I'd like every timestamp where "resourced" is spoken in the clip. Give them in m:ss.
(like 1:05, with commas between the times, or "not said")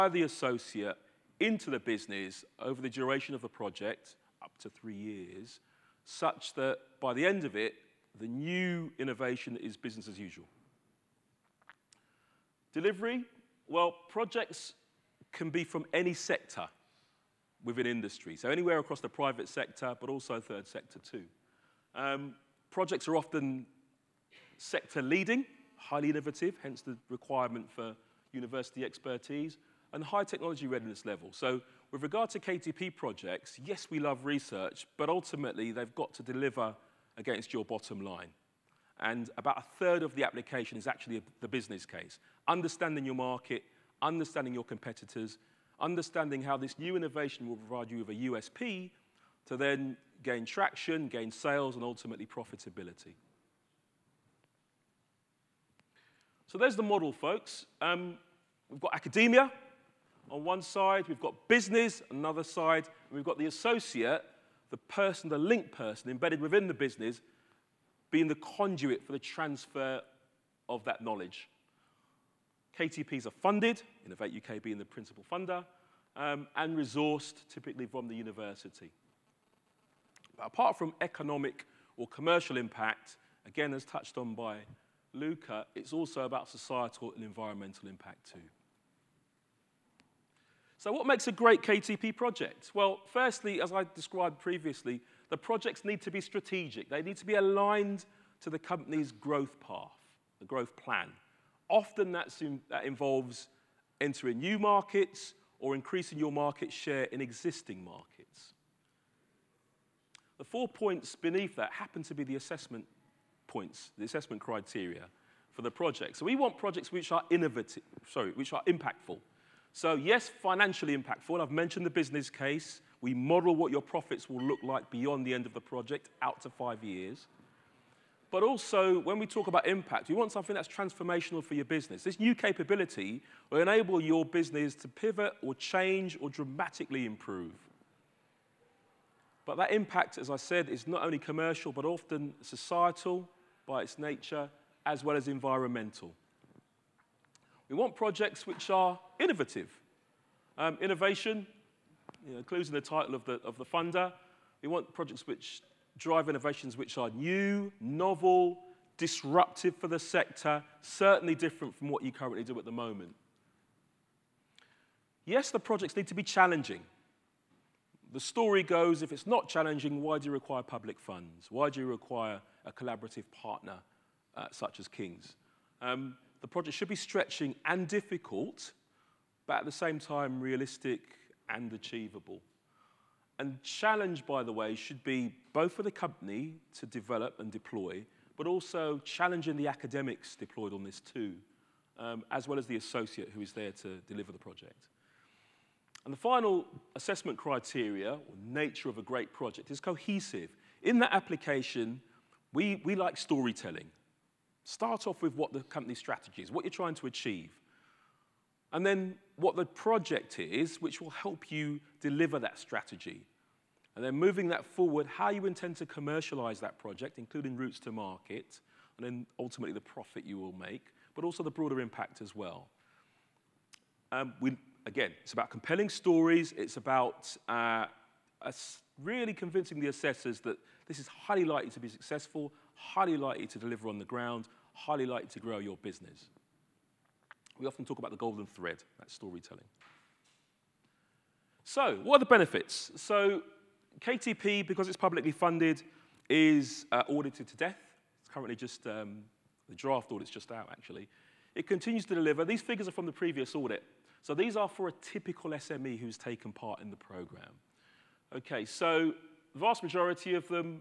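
1:16.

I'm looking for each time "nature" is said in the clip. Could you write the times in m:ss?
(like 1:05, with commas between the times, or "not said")
2:23, 3:18.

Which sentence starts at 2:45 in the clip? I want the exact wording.
Yes, the projects need to be challenging.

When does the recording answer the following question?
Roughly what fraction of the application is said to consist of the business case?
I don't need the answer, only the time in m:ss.
0:39.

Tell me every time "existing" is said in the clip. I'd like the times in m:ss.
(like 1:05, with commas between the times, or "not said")
1:47.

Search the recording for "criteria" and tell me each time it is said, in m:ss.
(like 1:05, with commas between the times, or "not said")
1:54, 3:17.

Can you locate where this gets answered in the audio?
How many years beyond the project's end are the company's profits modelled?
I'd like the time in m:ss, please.
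2:06.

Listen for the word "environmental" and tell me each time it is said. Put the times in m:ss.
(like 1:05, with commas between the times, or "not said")
1:27, 2:25.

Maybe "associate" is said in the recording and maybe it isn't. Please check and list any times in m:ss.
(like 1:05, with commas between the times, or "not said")
0:00, 1:03, 3:12.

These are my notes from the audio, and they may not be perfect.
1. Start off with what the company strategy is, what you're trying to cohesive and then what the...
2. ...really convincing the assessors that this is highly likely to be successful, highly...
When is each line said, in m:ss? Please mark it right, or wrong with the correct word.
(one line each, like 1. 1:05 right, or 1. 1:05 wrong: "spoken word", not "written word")
1. 3:24 wrong: "achieve", not "cohesive"
2. 3:49 right.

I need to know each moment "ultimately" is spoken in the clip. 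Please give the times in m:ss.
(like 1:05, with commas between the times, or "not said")
0:35, 0:51, 3:39.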